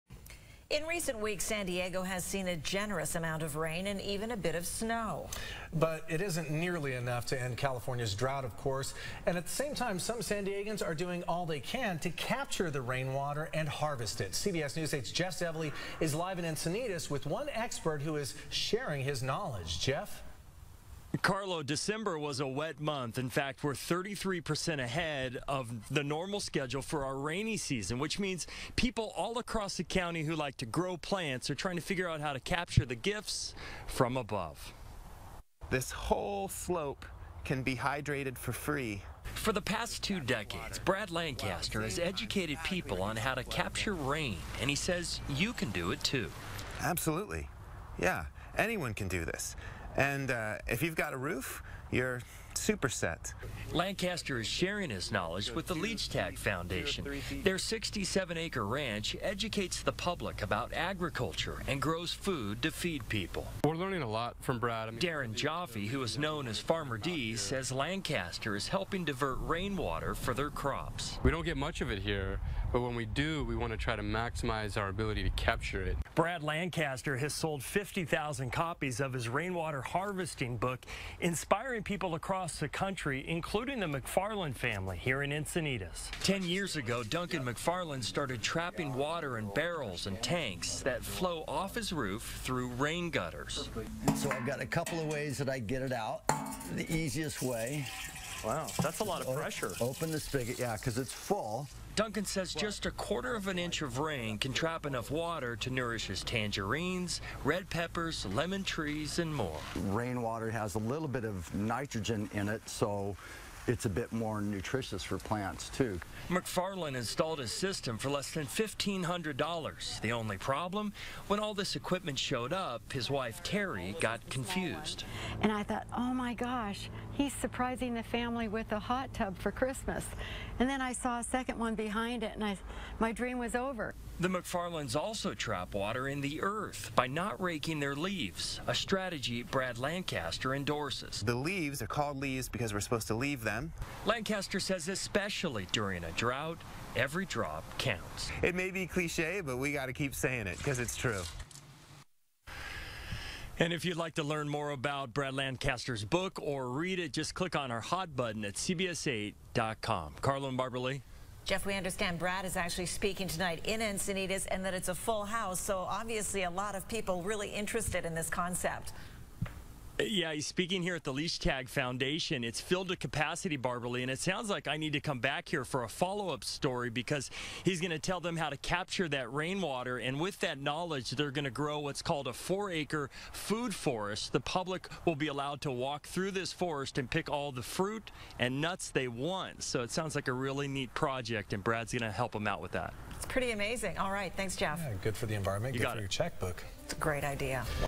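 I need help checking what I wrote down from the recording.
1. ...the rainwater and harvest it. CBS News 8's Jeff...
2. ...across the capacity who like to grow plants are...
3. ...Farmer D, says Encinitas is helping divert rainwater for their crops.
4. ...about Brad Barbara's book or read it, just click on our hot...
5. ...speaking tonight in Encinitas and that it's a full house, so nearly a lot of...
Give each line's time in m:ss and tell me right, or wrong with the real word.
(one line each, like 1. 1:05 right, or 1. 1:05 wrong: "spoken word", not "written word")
1. 0:12 right
2. 0:29 wrong: "county", not "capacity"
3. 1:06 wrong: "Lancaster", not "Encinitas"
4. 2:34 wrong: "Lancaster", not "Barbara"
5. 2:42 wrong: "obviously", not "nearly".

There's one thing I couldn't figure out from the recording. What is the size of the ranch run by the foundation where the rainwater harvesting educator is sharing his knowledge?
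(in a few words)
67 acre.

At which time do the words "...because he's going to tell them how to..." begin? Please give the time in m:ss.
2:56.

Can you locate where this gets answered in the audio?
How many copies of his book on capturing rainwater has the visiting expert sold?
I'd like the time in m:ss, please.
1:17.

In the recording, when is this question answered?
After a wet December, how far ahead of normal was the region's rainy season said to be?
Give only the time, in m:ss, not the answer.
0:23.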